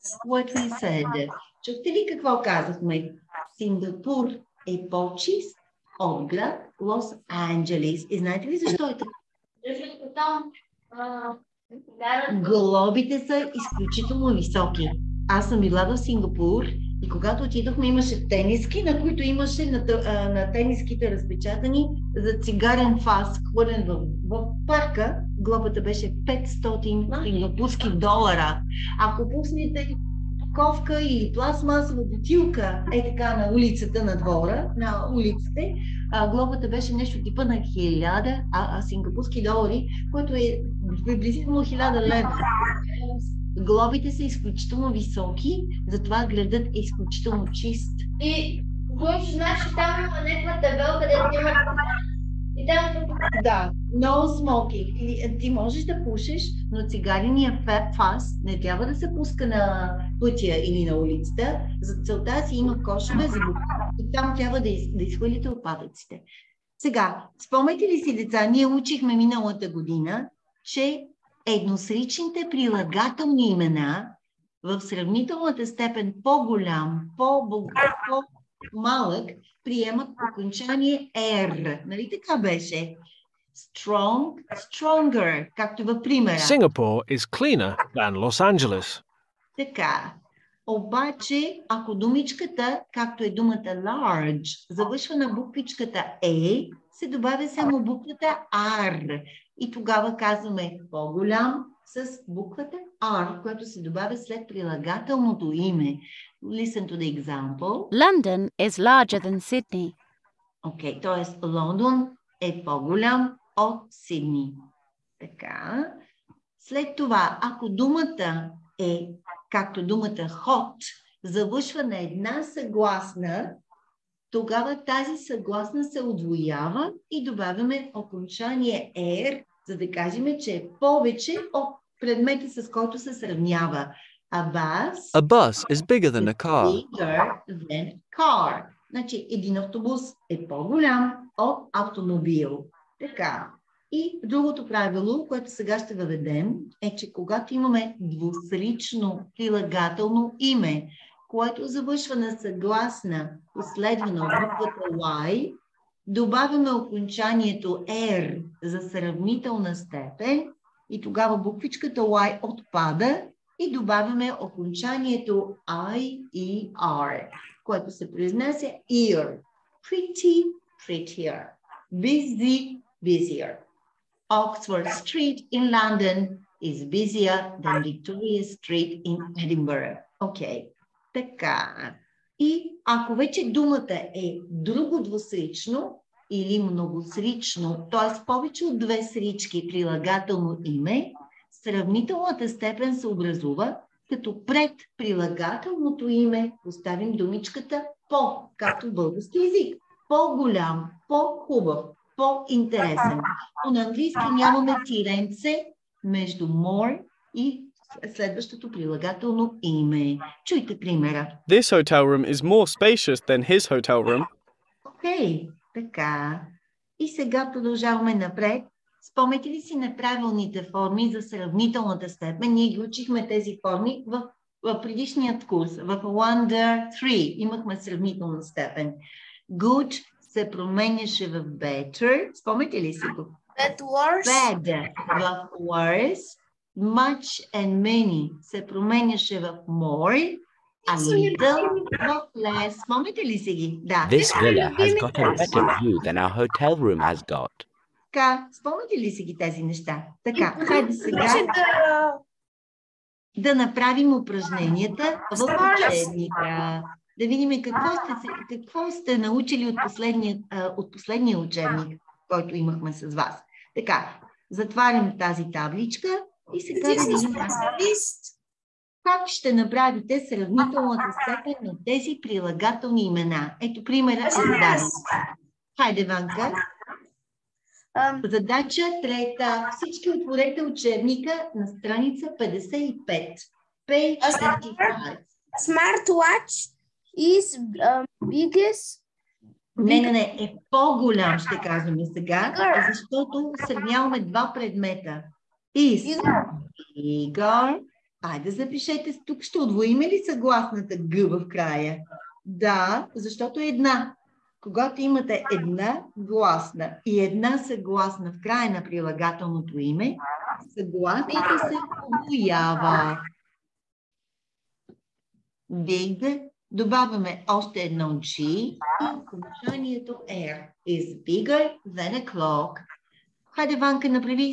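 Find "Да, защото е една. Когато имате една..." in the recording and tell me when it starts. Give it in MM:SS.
05:02.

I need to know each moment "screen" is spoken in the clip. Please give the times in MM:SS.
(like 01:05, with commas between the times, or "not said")
not said.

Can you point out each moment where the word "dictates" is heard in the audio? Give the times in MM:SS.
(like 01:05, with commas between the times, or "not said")
not said.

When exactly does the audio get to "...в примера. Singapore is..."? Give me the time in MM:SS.
01:25.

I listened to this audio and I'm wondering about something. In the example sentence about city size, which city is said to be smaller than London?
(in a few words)
Sydney.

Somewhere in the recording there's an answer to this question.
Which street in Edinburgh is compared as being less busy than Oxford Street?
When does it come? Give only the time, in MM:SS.
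02:57.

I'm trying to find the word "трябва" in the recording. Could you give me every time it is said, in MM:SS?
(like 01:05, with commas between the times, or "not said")
00:58, 01:04.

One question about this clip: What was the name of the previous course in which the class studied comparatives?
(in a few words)
Wonder 3.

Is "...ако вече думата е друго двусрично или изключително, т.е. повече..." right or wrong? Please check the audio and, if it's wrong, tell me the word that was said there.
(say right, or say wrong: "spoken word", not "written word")
wrong: "многосрично", not "изключително".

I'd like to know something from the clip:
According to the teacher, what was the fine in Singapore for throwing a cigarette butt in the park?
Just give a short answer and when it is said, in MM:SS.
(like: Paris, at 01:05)
500 Singapore dollars, at 00:26.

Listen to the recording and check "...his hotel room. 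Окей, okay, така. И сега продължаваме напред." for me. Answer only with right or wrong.
right.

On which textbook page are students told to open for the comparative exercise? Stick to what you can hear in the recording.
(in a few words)
55.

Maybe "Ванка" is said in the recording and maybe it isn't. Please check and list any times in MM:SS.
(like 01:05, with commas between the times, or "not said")
04:36, 05:23.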